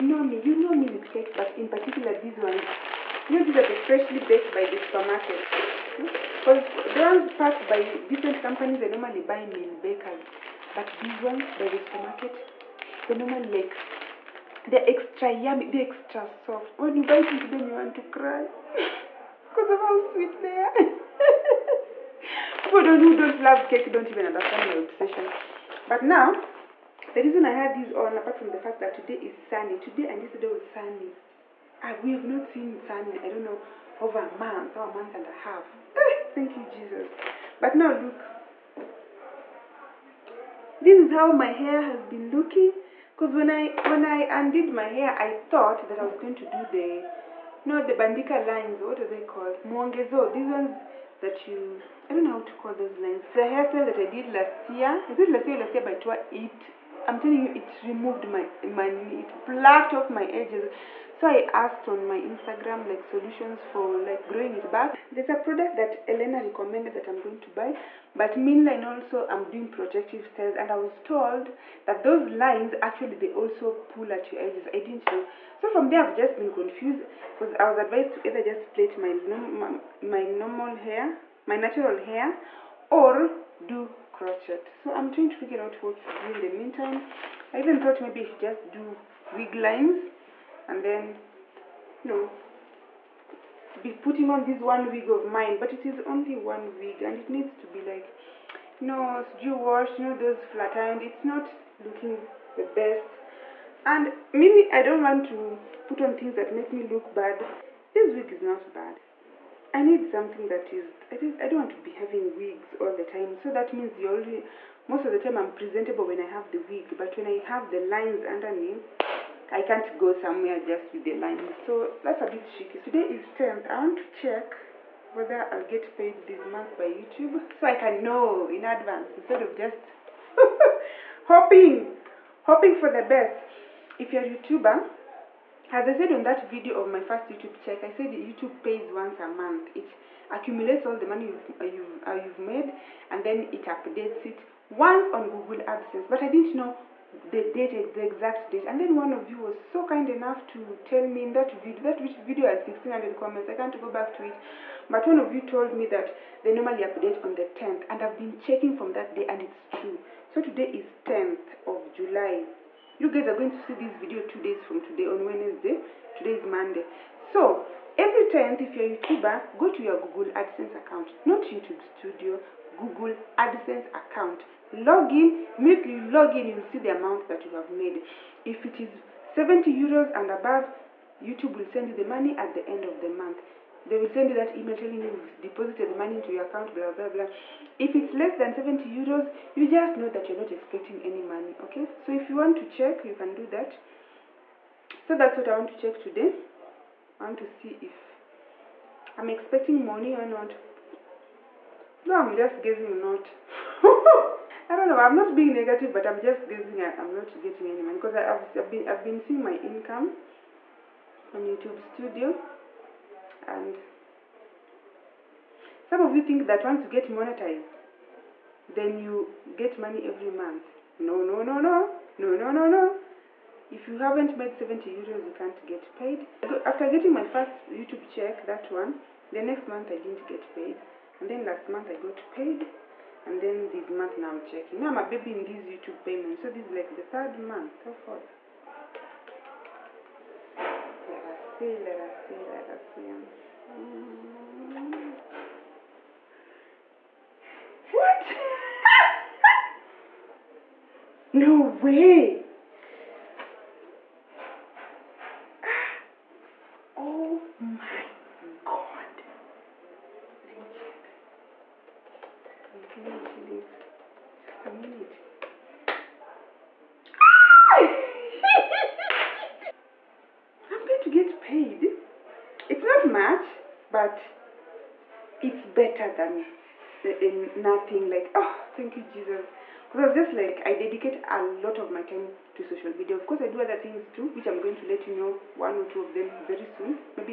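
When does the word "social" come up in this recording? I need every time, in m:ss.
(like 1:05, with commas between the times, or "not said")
4:42.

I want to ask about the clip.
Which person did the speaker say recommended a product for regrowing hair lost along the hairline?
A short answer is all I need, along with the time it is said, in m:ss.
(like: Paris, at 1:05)
Elena, at 1:06.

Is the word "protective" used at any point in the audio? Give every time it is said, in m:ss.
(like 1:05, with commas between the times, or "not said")
1:09.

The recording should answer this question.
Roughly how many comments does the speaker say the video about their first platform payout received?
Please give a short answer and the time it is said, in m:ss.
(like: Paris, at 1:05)
1600, at 2:32.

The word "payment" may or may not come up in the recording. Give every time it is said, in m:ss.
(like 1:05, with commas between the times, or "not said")
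3:56.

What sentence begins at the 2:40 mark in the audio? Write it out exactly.
So today is 10th of July.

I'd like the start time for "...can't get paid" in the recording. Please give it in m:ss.
3:45.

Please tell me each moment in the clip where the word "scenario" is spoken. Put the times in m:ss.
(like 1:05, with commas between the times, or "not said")
not said.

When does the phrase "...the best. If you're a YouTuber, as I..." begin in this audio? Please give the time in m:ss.
2:12.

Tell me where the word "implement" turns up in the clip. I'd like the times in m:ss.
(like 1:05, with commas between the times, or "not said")
not said.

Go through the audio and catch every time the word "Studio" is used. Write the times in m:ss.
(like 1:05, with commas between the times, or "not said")
2:51, 3:31.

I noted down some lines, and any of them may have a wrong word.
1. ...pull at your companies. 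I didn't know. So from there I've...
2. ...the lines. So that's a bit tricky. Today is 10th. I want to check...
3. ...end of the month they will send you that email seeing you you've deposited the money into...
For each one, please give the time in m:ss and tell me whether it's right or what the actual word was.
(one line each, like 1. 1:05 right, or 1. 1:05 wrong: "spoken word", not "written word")
1. 1:13 wrong: "edges", not "companies"
2. 2:01 right
3. 3:02 wrong: "telling", not "seeing".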